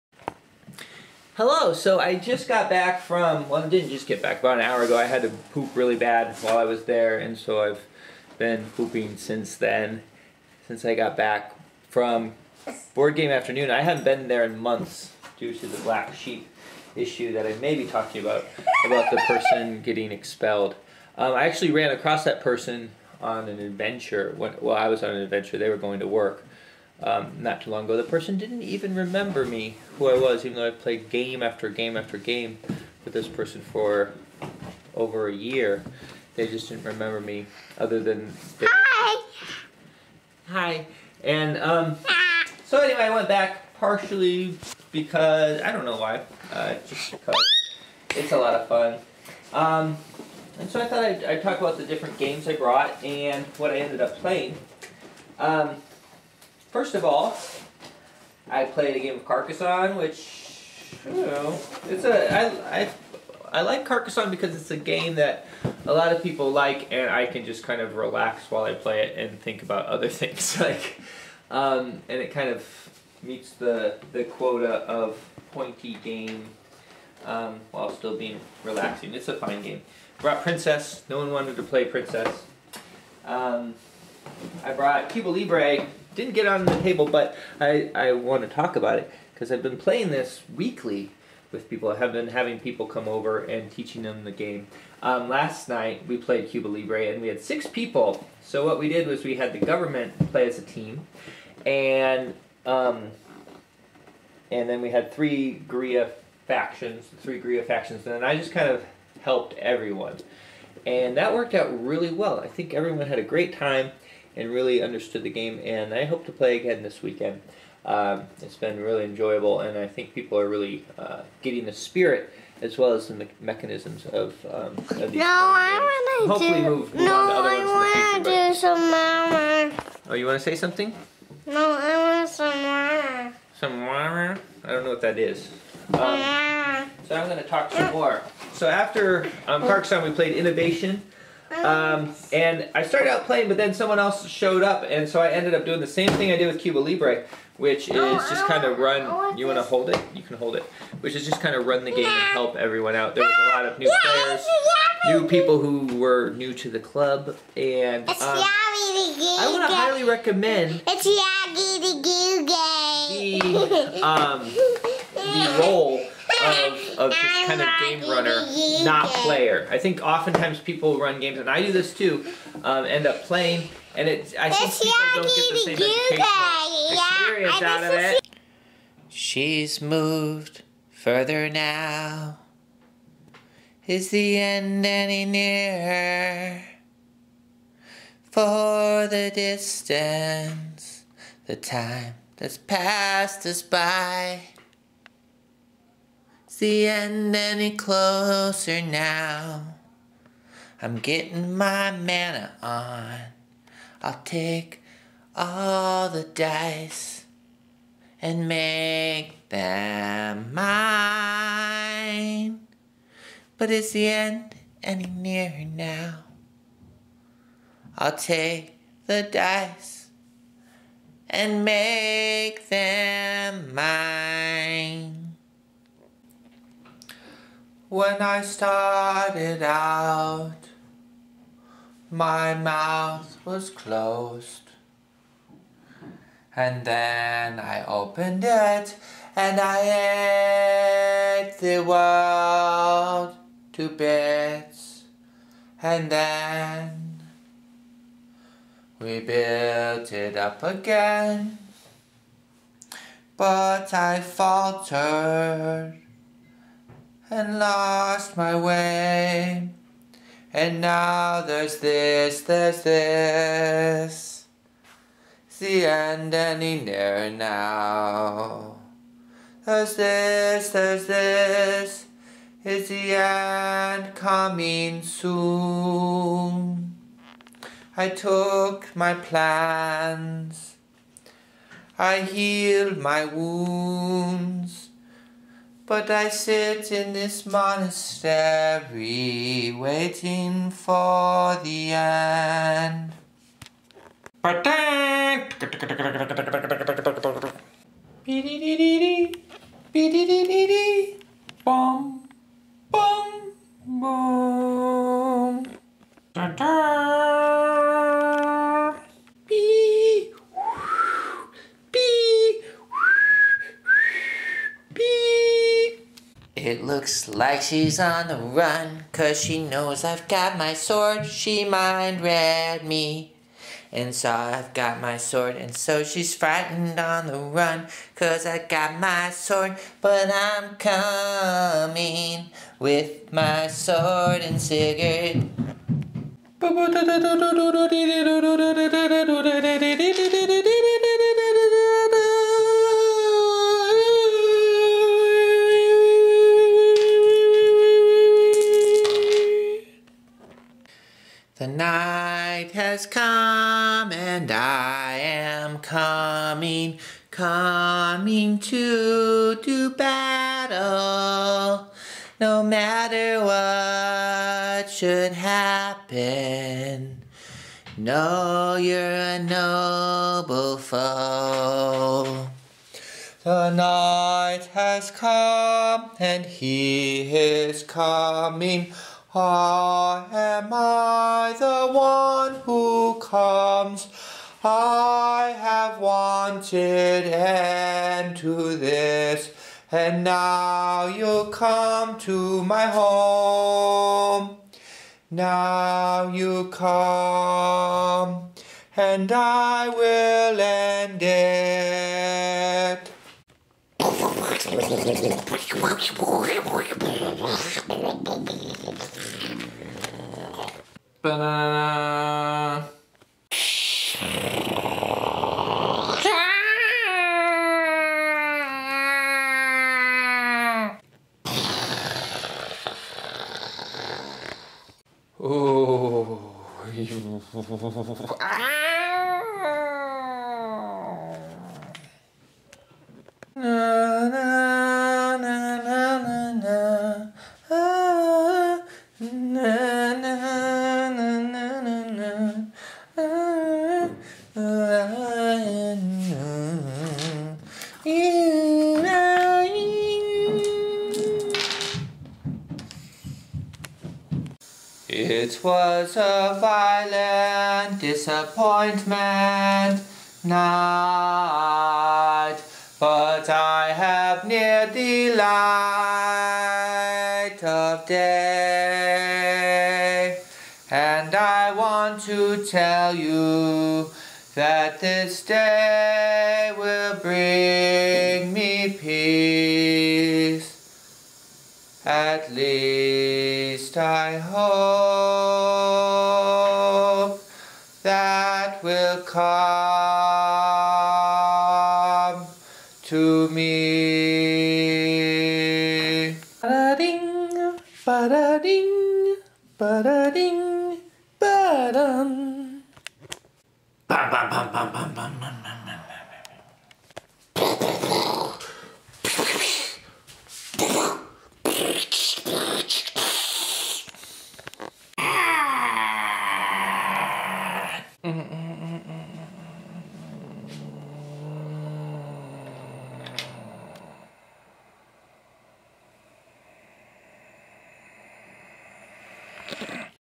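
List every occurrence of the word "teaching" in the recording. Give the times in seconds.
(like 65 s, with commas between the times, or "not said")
93 s.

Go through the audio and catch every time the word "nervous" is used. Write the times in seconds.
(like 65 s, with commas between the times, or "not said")
not said.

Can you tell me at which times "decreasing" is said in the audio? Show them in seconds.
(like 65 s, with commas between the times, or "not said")
not said.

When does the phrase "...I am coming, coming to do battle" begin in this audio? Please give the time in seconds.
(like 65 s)
354 s.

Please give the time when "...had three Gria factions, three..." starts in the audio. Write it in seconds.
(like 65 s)
104 s.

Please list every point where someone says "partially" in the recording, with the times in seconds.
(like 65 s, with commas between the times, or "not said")
43 s.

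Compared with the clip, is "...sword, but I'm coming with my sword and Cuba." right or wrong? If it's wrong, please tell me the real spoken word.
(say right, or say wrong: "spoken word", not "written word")
wrong: "Sigurd", not "Cuba".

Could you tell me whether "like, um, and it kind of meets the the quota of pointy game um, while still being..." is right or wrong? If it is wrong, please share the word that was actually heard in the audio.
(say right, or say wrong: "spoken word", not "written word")
right.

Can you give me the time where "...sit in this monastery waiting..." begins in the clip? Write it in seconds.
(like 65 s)
286 s.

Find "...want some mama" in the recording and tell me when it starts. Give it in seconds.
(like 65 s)
132 s.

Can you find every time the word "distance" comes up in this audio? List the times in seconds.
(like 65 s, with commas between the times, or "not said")
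189 s.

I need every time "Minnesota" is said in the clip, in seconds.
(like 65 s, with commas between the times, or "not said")
not said.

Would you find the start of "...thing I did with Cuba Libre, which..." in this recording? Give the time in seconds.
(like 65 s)
146 s.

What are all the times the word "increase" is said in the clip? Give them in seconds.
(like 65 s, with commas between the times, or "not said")
not said.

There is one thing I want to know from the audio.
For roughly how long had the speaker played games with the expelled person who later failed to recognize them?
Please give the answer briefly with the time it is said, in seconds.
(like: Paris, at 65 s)
over a year, at 34 s.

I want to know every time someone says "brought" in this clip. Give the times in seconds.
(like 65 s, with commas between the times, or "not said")
52 s, 80 s, 84 s.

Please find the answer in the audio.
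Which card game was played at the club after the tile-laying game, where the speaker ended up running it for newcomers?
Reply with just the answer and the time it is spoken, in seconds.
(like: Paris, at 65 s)
Innovation, at 140 s.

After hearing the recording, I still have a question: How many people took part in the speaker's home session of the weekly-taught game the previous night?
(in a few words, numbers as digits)
6.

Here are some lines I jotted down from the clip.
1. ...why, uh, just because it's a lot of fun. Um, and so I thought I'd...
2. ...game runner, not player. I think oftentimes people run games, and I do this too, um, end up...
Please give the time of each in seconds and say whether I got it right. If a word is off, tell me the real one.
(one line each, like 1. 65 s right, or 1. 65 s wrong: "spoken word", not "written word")
1. 45 s right
2. 167 s right.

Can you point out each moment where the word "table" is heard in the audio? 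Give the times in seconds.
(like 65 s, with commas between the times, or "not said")
86 s.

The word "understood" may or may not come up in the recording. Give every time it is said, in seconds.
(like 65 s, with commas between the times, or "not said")
114 s.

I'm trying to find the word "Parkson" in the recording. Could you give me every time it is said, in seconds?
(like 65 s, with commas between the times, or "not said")
139 s.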